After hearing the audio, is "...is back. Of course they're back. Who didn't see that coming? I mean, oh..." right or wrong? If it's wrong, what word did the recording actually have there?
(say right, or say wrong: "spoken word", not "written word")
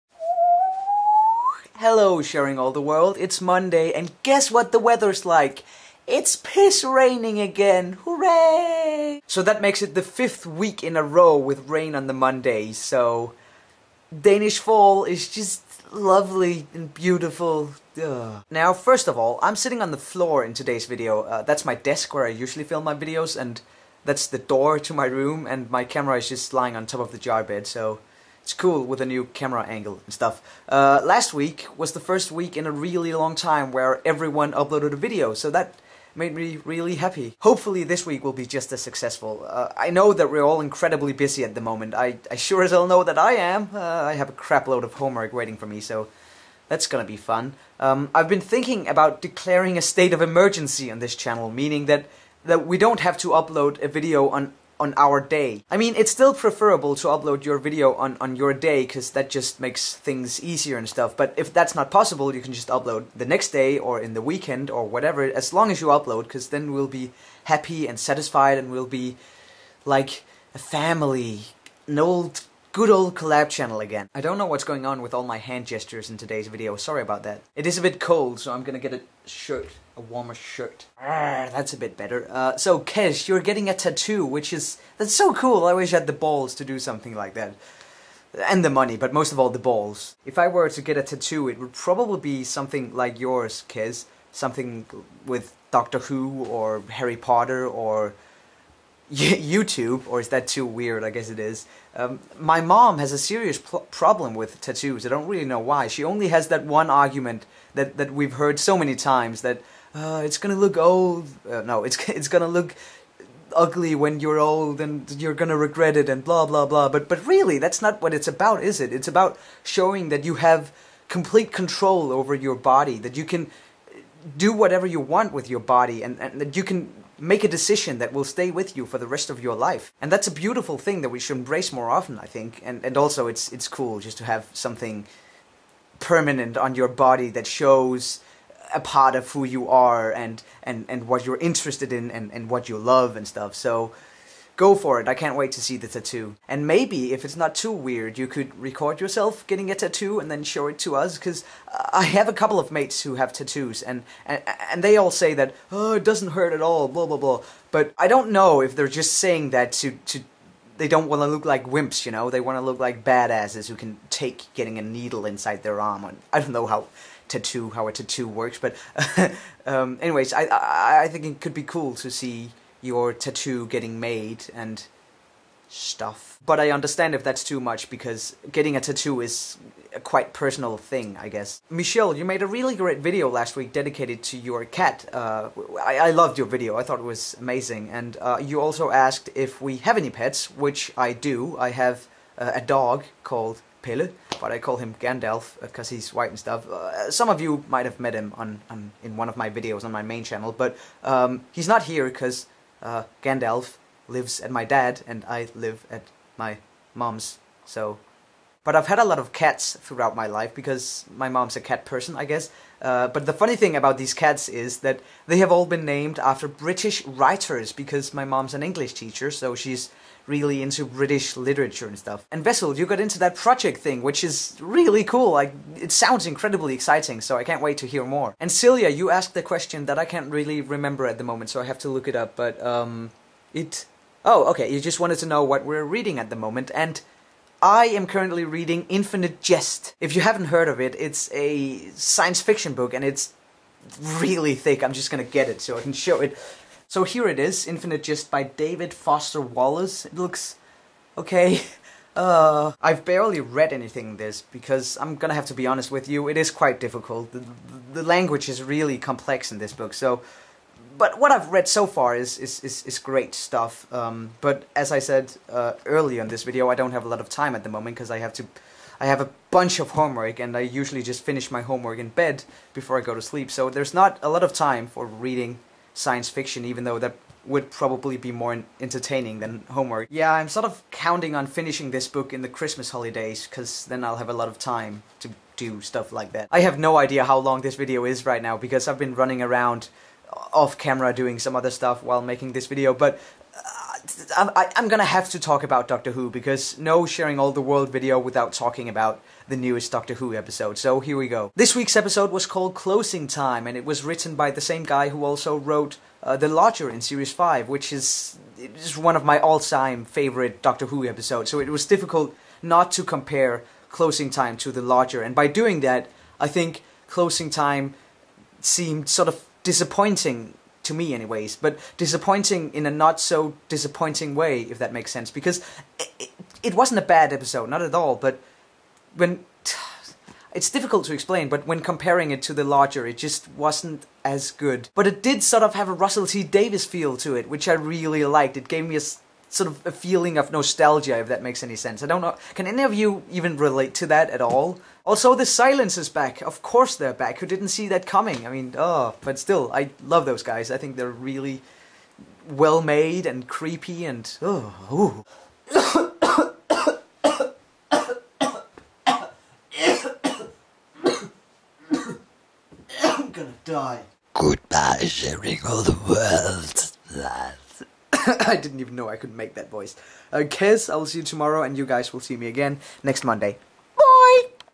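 right.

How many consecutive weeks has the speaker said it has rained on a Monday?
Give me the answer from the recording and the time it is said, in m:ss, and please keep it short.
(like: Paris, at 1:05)
5, at 0:10.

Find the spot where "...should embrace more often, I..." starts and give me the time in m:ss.
2:11.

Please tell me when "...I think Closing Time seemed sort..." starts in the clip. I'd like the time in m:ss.
5:16.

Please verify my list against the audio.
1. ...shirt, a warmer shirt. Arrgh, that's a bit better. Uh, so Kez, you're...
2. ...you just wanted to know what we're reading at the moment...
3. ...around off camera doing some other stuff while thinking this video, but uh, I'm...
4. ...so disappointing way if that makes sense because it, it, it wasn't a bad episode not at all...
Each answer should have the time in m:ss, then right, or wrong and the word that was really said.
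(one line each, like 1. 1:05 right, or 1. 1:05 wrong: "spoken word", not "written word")
1. 1:19 right
2. 3:54 right
3. 4:49 wrong: "making", not "thinking"
4. 5:23 right.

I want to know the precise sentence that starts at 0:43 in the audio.
Uh, I have a crapload of homework waiting for me, so that's gonna be fun.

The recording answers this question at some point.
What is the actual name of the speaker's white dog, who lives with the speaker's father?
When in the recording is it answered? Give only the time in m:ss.
3:13.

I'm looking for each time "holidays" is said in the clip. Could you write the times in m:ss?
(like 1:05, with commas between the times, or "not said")
4:42.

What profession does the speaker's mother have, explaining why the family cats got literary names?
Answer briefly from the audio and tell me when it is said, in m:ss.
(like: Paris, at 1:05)
English teacher, at 3:38.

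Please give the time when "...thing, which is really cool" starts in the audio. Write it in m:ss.
3:43.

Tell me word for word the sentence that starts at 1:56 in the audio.
But but really, that's not what it's about, is it?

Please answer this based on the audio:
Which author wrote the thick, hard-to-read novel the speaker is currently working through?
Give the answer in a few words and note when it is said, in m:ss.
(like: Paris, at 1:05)
David Foster Wallace, at 4:08.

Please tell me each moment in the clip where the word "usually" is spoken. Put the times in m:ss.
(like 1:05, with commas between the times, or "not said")
0:22, 4:30.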